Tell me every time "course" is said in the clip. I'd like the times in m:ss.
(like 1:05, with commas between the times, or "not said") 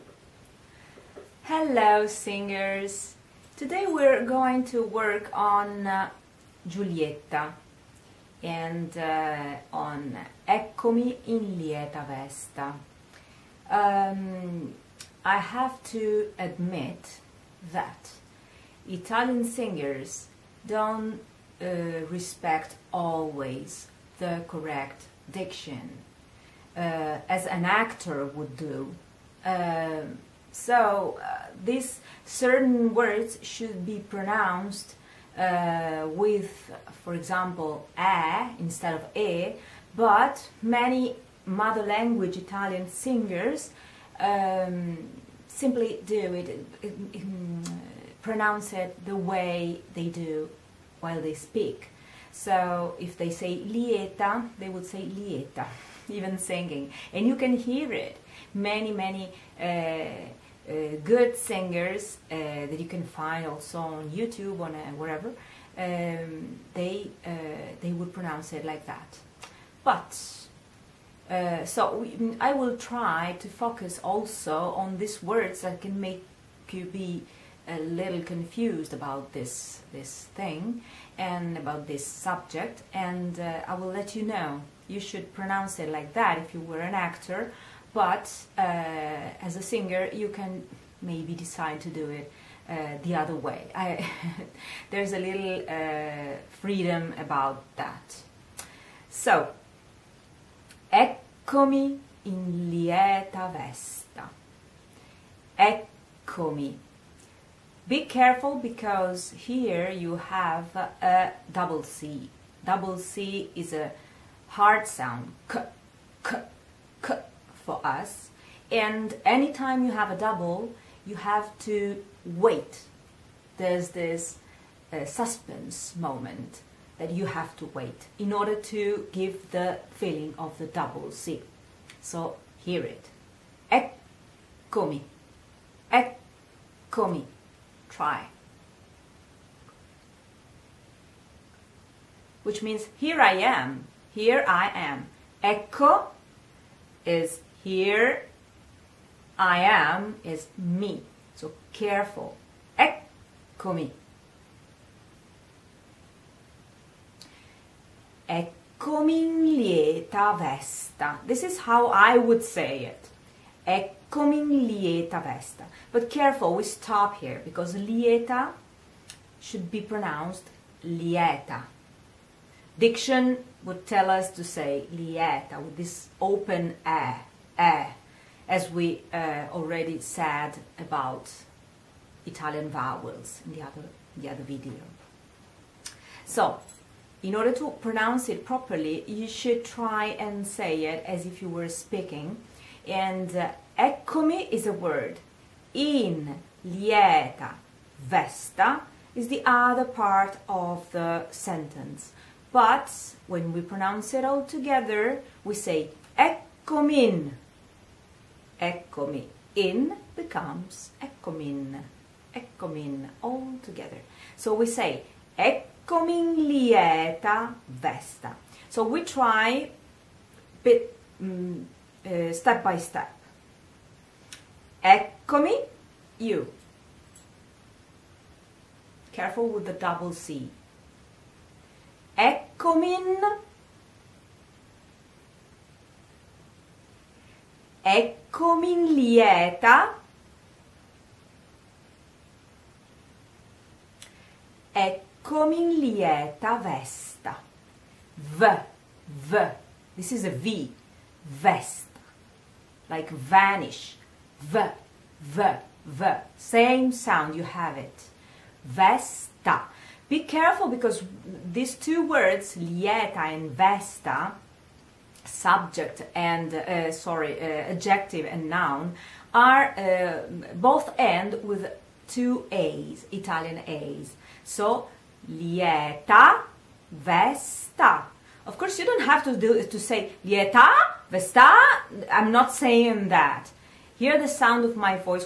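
4:38.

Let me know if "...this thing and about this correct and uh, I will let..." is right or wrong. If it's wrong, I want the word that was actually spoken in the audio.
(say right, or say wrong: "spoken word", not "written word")
wrong: "subject", not "correct".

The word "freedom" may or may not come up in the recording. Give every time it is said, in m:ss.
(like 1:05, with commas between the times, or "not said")
1:36.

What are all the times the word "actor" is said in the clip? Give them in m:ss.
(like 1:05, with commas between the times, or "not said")
0:27, 1:26.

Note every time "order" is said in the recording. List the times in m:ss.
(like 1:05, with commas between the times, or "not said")
2:08, 3:07.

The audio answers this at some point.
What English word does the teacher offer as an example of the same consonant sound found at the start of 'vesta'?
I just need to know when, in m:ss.
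4:13.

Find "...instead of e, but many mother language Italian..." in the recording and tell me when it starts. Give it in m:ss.
0:38.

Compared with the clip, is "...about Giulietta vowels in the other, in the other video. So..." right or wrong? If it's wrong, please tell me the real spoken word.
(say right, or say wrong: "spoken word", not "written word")
wrong: "Italian", not "Giulietta".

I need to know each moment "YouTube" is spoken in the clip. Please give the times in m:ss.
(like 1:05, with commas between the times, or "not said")
1:04.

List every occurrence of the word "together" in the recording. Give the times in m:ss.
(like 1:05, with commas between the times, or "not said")
3:24, 3:33.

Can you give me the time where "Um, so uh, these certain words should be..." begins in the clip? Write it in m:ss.
0:29.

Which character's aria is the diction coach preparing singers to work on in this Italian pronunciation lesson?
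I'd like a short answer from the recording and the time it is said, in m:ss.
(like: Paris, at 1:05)
Giulietta, at 0:06.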